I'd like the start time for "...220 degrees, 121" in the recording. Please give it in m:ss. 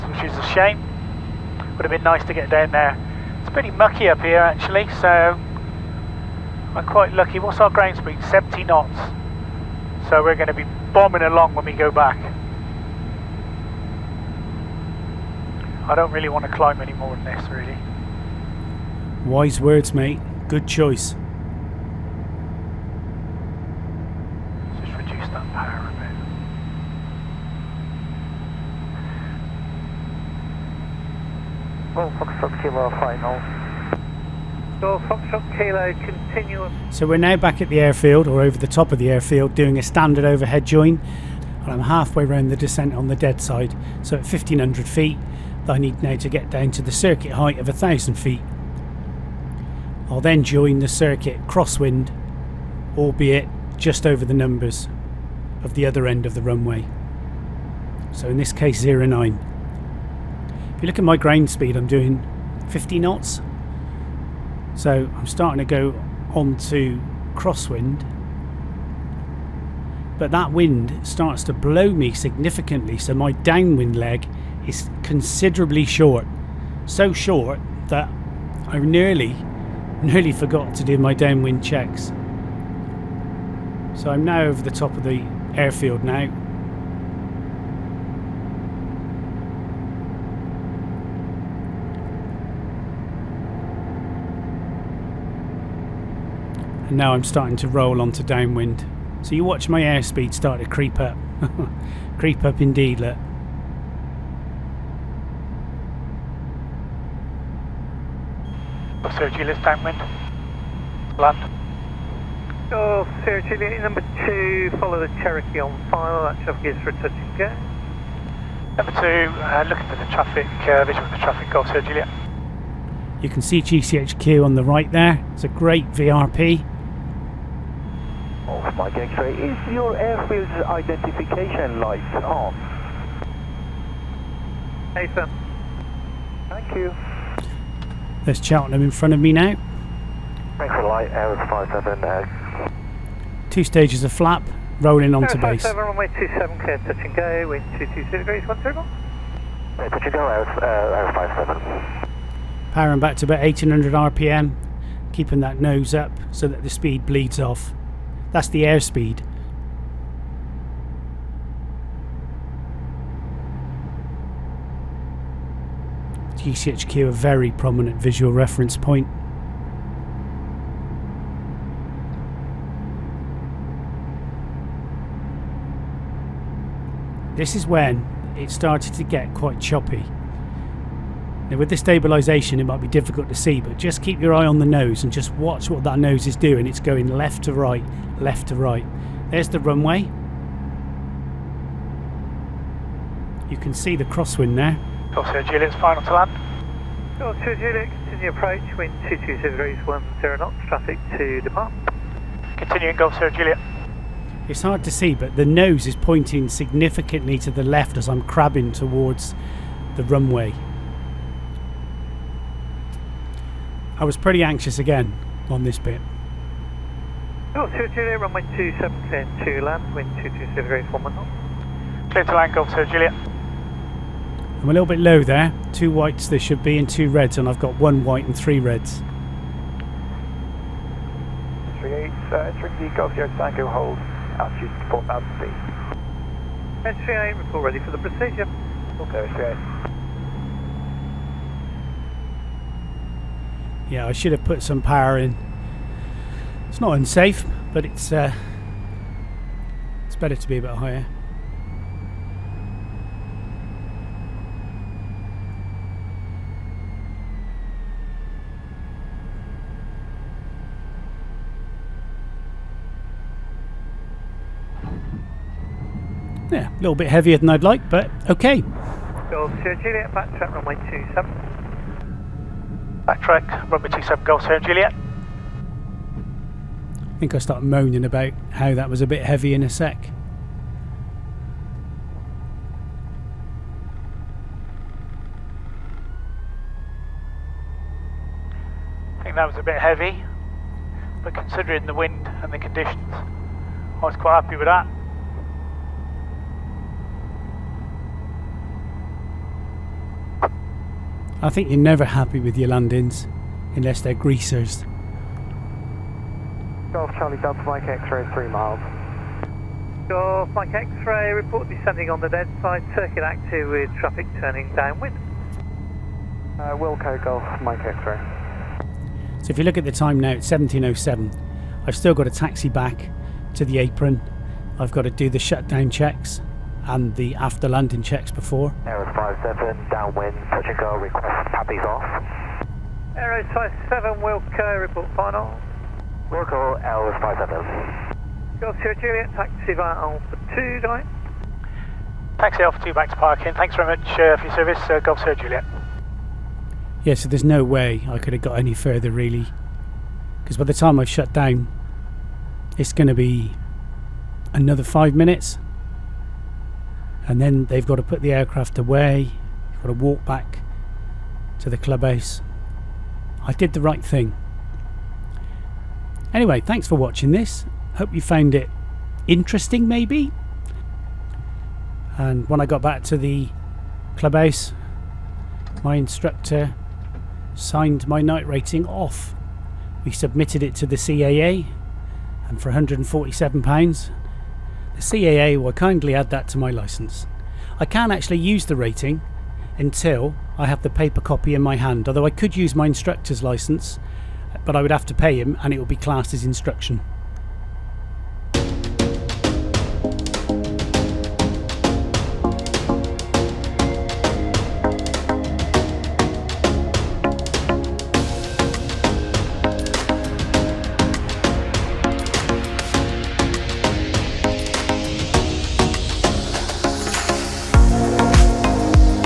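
2:27.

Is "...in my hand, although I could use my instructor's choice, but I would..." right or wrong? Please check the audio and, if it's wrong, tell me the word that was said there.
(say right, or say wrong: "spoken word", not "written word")
wrong: "licence", not "choice".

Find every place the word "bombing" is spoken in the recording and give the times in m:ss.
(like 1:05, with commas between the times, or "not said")
0:10.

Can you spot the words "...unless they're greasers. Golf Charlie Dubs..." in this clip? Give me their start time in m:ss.
5:03.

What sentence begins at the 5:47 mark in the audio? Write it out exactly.
Yeah, so there's no way I could have got any further really.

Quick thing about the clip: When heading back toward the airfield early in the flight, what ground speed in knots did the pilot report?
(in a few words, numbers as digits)
70 knots.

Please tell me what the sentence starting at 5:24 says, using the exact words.
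I've got to do the shutdown checks and the after landing checks before.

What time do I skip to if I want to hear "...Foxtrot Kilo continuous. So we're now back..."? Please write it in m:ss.
0:35.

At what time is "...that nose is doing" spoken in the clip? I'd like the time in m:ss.
3:05.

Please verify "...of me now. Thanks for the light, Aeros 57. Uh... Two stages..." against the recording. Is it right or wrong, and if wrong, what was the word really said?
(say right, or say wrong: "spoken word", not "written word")
right.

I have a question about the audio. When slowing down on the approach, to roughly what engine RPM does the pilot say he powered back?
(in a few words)
1800 RPM.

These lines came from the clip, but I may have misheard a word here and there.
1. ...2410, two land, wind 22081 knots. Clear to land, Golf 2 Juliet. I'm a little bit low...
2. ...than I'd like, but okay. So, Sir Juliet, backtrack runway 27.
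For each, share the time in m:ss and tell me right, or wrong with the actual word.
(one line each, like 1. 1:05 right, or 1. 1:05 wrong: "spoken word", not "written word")
1. 3:38 wrong: "2710", not "2410"
2. 4:27 right.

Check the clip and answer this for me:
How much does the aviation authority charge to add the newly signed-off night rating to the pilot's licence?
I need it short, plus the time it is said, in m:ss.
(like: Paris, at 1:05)
£147, at 6:22.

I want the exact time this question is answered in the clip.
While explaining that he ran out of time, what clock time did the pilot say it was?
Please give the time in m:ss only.
5:20.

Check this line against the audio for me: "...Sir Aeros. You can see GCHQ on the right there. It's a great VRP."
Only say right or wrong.
wrong.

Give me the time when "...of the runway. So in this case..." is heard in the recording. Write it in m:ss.
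0:56.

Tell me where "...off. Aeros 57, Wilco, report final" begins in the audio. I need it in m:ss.
5:31.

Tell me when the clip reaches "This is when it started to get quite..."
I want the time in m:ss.
2:57.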